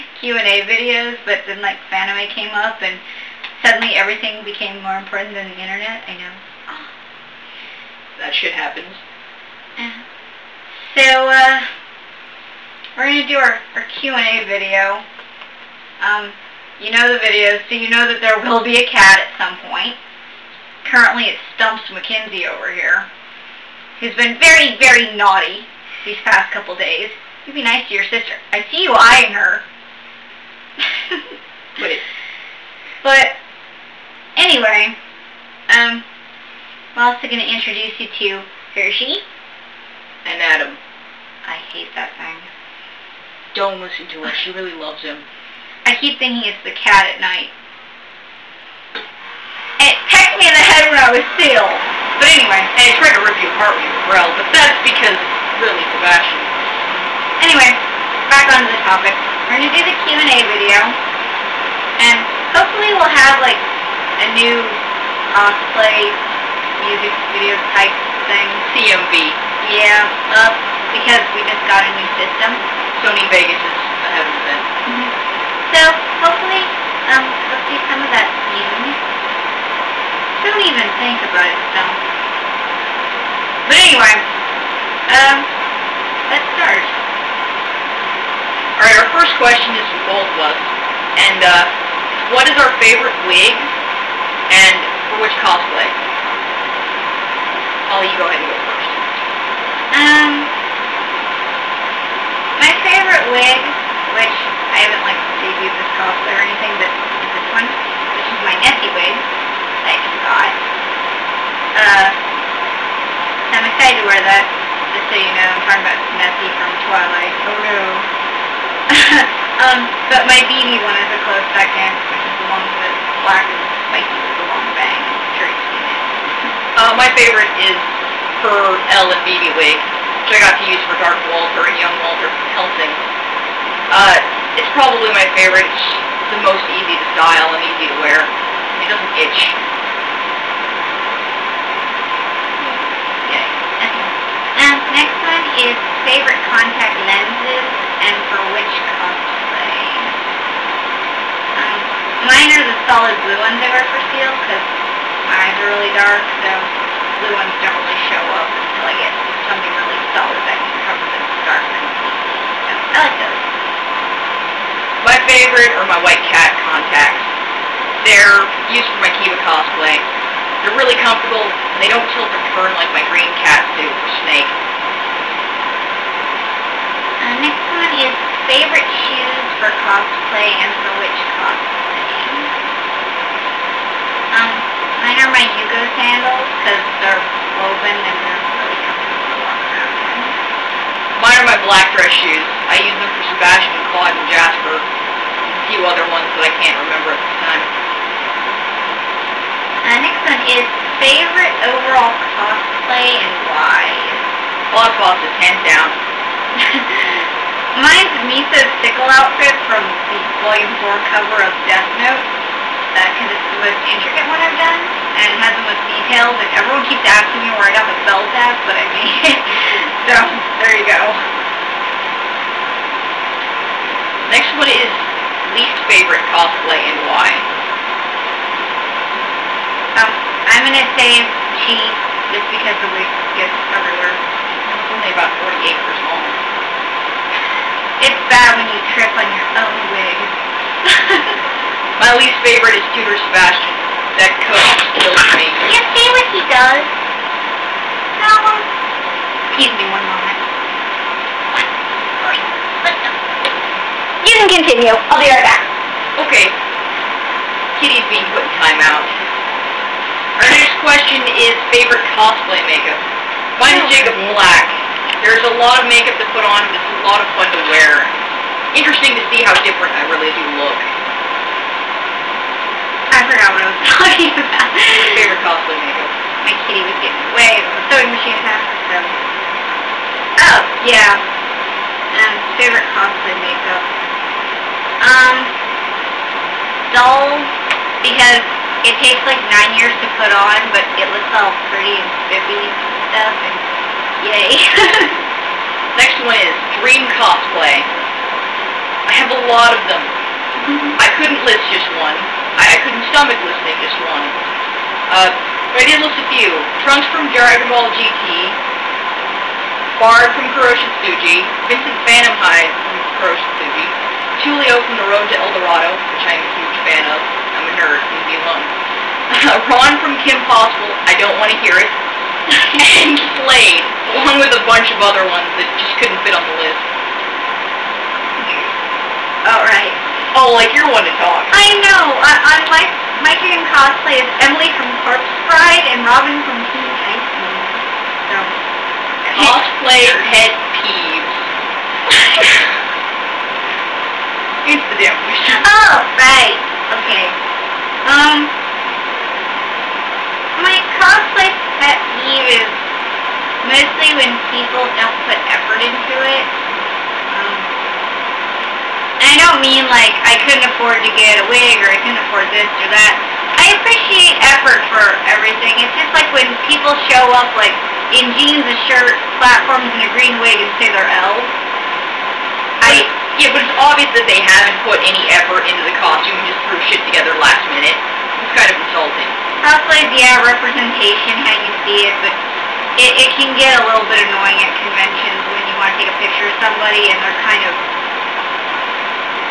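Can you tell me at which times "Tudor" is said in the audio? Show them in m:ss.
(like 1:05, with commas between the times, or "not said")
4:02.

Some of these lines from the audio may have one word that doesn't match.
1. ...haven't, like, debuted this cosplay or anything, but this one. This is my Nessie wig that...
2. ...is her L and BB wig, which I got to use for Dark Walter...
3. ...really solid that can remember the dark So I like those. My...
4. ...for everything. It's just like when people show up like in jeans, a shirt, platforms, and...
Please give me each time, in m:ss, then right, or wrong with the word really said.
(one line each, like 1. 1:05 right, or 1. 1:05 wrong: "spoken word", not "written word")
1. 1:44 right
2. 2:07 right
3. 2:39 wrong: "cover", not "remember"
4. 6:04 right.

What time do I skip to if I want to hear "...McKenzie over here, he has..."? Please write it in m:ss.
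0:21.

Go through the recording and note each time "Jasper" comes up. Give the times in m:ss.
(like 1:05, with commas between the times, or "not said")
3:14.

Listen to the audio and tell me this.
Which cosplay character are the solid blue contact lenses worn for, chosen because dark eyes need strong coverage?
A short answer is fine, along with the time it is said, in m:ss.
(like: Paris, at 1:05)
Ciel, at 2:34.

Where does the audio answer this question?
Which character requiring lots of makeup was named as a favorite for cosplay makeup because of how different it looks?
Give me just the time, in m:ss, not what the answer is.
4:23.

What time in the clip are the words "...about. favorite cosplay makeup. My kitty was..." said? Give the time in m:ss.
4:34.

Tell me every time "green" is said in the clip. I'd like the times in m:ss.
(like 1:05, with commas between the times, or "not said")
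2:53, 6:10.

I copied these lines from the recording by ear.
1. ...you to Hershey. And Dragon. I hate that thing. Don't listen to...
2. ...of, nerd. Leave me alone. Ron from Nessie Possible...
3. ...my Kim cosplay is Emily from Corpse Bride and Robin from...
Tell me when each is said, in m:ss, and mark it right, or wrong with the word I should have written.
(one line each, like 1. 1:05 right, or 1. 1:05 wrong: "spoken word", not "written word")
1. 0:37 wrong: "Adam", not "Dragon"
2. 5:17 wrong: "Kim", not "Nessie"
3. 5:33 right.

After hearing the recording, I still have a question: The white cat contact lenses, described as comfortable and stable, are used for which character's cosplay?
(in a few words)
Kiva.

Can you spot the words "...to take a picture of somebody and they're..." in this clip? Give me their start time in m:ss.
6:25.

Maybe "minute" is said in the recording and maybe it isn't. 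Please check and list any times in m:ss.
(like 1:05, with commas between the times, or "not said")
6:17.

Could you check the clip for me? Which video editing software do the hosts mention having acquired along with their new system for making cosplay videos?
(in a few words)
Sony Vegas.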